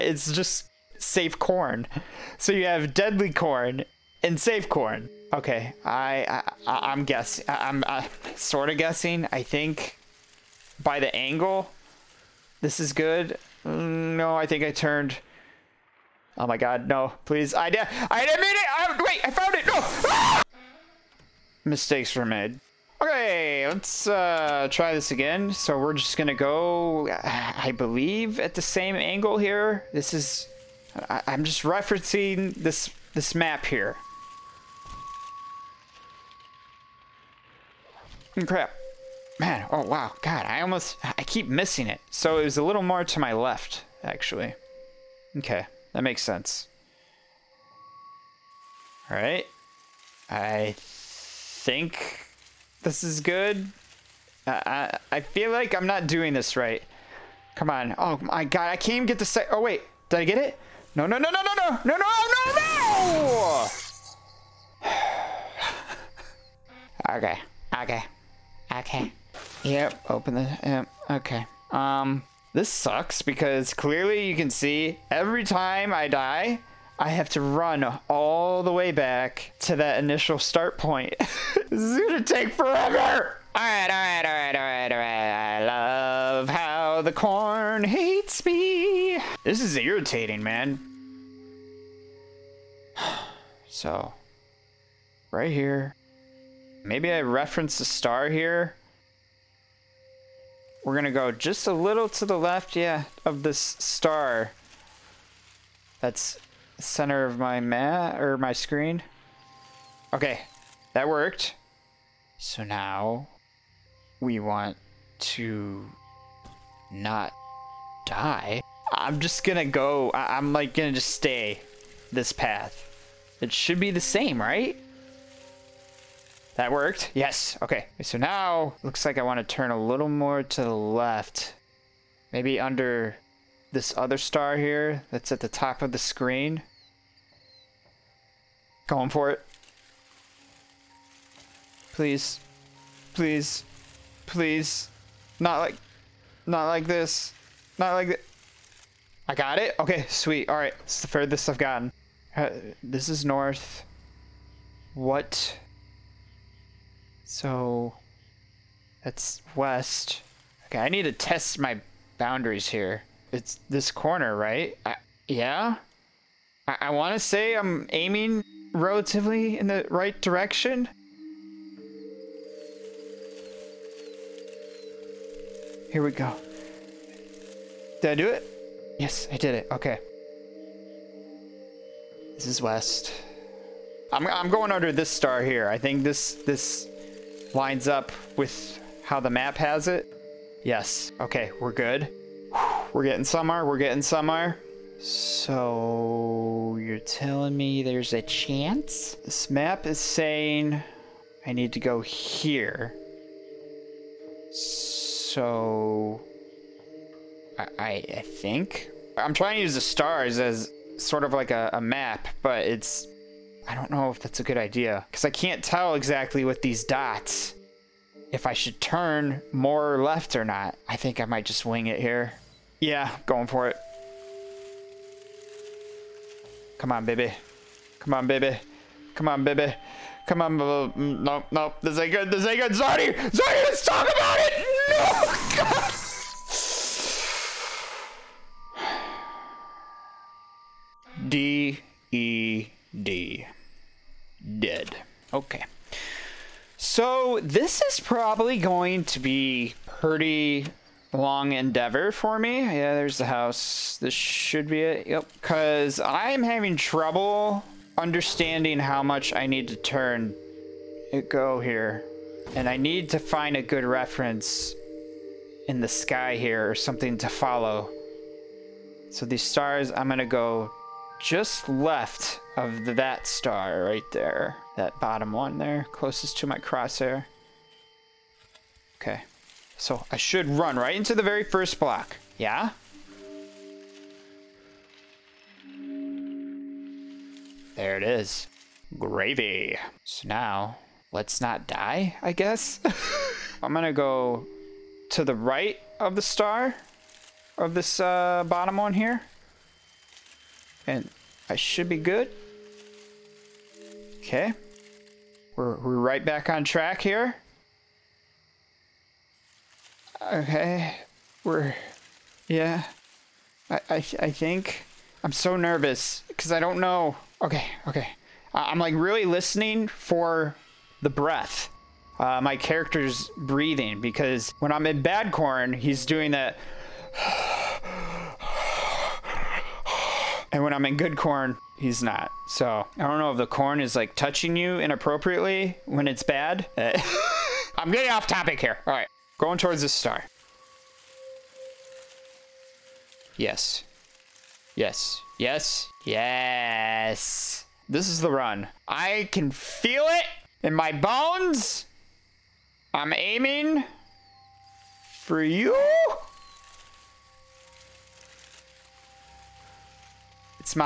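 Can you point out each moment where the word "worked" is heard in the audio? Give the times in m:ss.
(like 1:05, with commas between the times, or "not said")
1:51, 2:06.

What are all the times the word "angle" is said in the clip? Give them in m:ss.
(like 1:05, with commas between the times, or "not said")
0:11, 0:28.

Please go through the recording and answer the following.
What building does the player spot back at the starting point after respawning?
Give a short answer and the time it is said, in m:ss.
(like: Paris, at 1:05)
The house, at 4:13.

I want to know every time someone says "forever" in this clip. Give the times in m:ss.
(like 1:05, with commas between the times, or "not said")
1:22.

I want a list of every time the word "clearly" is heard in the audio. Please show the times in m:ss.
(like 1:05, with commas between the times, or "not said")
1:13.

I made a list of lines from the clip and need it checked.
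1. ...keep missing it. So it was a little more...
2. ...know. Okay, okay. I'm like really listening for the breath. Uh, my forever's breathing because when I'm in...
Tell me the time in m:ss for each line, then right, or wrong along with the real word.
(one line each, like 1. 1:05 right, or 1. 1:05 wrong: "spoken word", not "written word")
1. 0:41 right
2. 5:16 wrong: "character", not "forever".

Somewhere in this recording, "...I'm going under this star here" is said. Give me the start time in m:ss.
3:04.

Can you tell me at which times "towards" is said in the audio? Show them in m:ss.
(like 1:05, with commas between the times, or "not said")
5:39.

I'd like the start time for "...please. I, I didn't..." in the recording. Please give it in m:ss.
0:17.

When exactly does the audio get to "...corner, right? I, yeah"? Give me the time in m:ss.
2:43.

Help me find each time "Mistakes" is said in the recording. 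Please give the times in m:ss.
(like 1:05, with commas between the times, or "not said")
0:21.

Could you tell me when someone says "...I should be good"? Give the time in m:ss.
5:01.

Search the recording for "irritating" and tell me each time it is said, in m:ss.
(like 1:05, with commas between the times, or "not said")
1:29.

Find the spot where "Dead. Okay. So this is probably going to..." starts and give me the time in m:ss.
4:04.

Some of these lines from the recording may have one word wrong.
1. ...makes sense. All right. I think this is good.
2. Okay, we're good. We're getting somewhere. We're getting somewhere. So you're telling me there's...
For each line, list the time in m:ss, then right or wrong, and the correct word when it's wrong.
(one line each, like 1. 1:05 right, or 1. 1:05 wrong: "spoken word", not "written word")
1. 0:46 right
2. 3:11 right.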